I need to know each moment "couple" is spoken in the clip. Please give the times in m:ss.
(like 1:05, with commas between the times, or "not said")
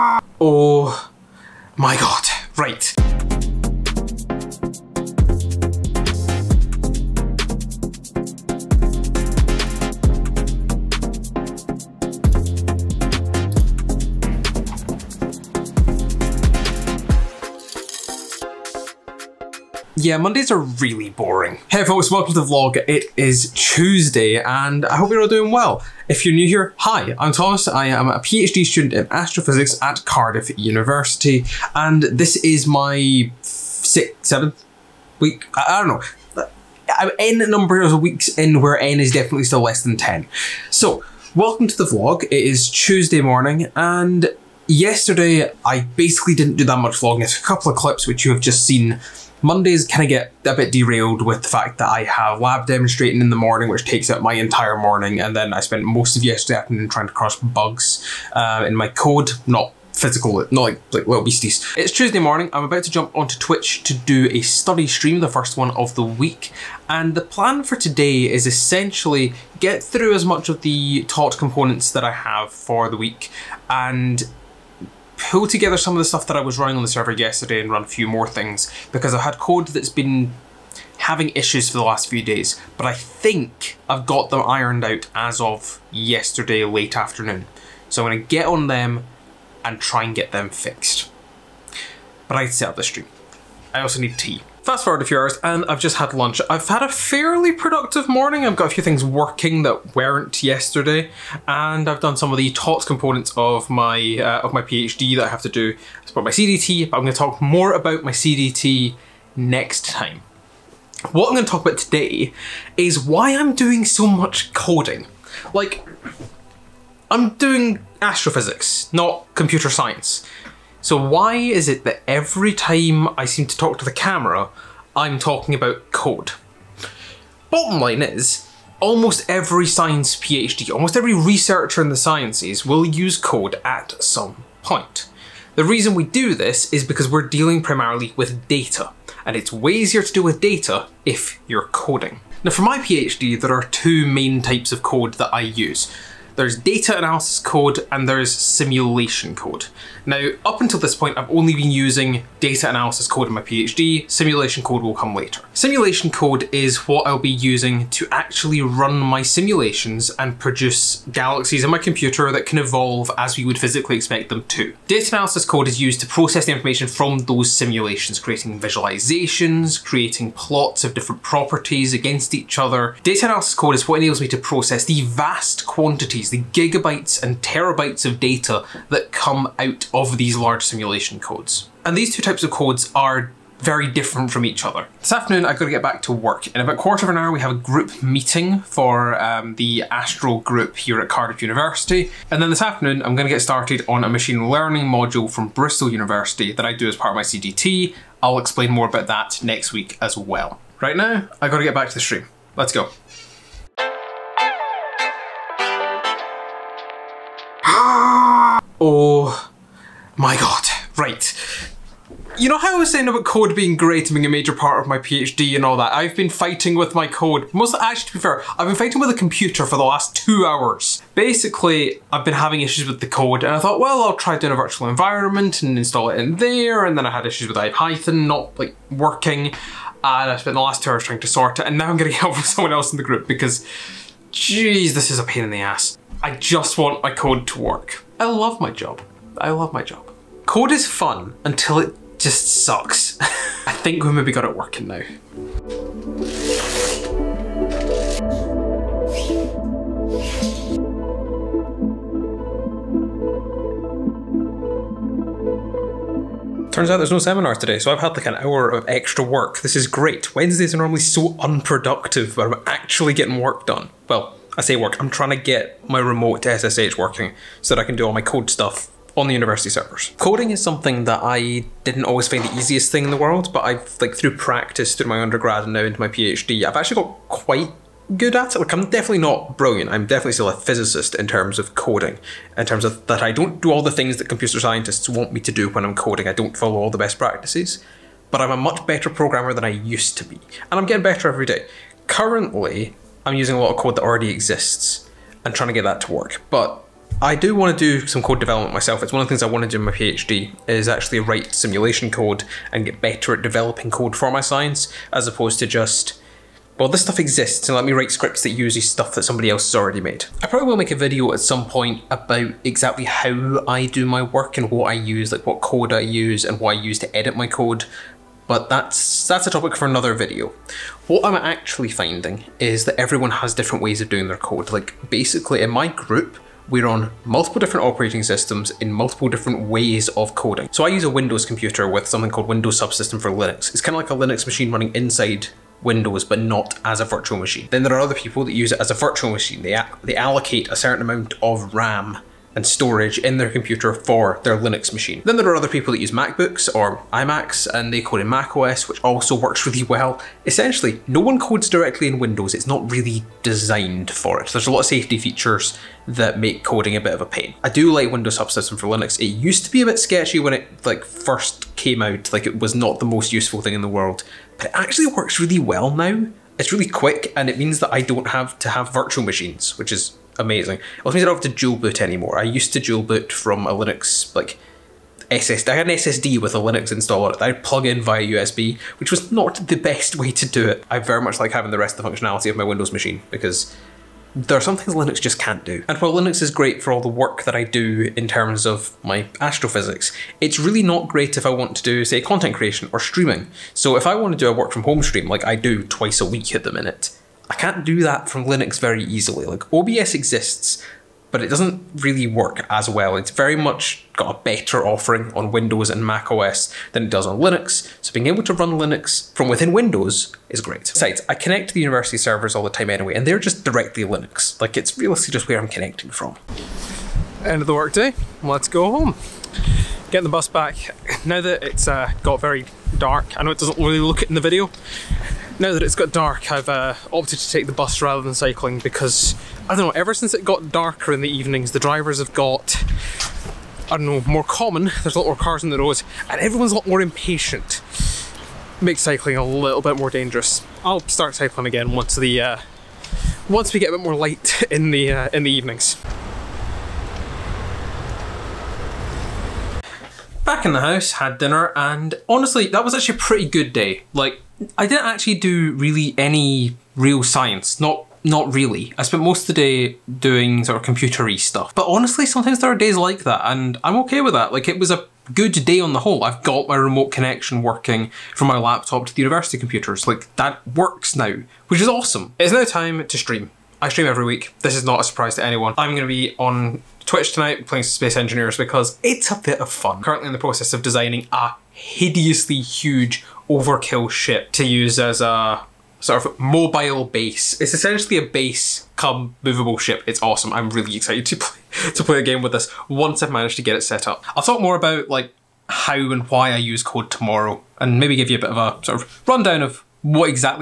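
0:47.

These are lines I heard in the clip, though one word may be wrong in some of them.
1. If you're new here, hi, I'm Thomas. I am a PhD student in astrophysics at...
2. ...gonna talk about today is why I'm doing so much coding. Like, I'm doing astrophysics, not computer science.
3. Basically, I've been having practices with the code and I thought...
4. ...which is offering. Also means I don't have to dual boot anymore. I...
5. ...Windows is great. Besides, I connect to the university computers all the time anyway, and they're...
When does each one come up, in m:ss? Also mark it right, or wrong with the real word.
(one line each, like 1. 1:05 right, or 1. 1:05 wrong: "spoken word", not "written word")
1. 0:26 right
2. 1:51 right
3. 3:41 wrong: "issues", not "practices"
4. 6:09 wrong: "amazing", not "offering"
5. 6:49 wrong: "servers", not "computers".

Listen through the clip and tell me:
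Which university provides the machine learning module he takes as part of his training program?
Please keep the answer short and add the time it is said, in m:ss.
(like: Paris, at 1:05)
Bristol University, at 3:15.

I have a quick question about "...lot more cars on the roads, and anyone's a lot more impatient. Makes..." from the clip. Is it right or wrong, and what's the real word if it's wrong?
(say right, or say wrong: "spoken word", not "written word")
wrong: "everyone", not "anyone".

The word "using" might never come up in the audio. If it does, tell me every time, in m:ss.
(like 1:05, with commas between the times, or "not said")
2:31, 2:37, 4:53.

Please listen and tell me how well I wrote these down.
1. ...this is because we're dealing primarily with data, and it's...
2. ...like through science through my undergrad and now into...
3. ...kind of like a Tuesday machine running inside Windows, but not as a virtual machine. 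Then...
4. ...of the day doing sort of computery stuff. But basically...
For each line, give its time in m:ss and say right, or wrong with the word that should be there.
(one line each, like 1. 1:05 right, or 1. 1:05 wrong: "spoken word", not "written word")
1. 2:16 right
2. 4:34 wrong: "practice", not "science"
3. 5:33 wrong: "Linux", not "Tuesday"
4. 7:39 wrong: "honestly", not "basically".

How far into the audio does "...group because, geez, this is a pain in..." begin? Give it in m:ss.
3:53.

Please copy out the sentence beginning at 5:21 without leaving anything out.
What I'm actually finding is that everyone has different ways of doing their code.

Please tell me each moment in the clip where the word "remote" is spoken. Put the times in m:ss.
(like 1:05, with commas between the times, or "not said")
4:26, 7:46.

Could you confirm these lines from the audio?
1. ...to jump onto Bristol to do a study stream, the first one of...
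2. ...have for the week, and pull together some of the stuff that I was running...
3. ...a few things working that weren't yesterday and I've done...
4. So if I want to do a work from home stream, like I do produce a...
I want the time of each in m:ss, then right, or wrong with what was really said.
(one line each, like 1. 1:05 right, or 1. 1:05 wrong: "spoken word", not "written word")
1. 1:02 wrong: "Twitch", not "Bristol"
2. 1:12 right
3. 1:38 right
4. 6:33 wrong: "twice", not "produce".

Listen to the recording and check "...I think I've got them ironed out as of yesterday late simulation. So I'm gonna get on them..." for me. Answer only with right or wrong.
wrong.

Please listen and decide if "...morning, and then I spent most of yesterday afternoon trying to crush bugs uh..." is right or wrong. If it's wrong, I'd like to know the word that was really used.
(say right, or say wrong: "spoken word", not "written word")
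right.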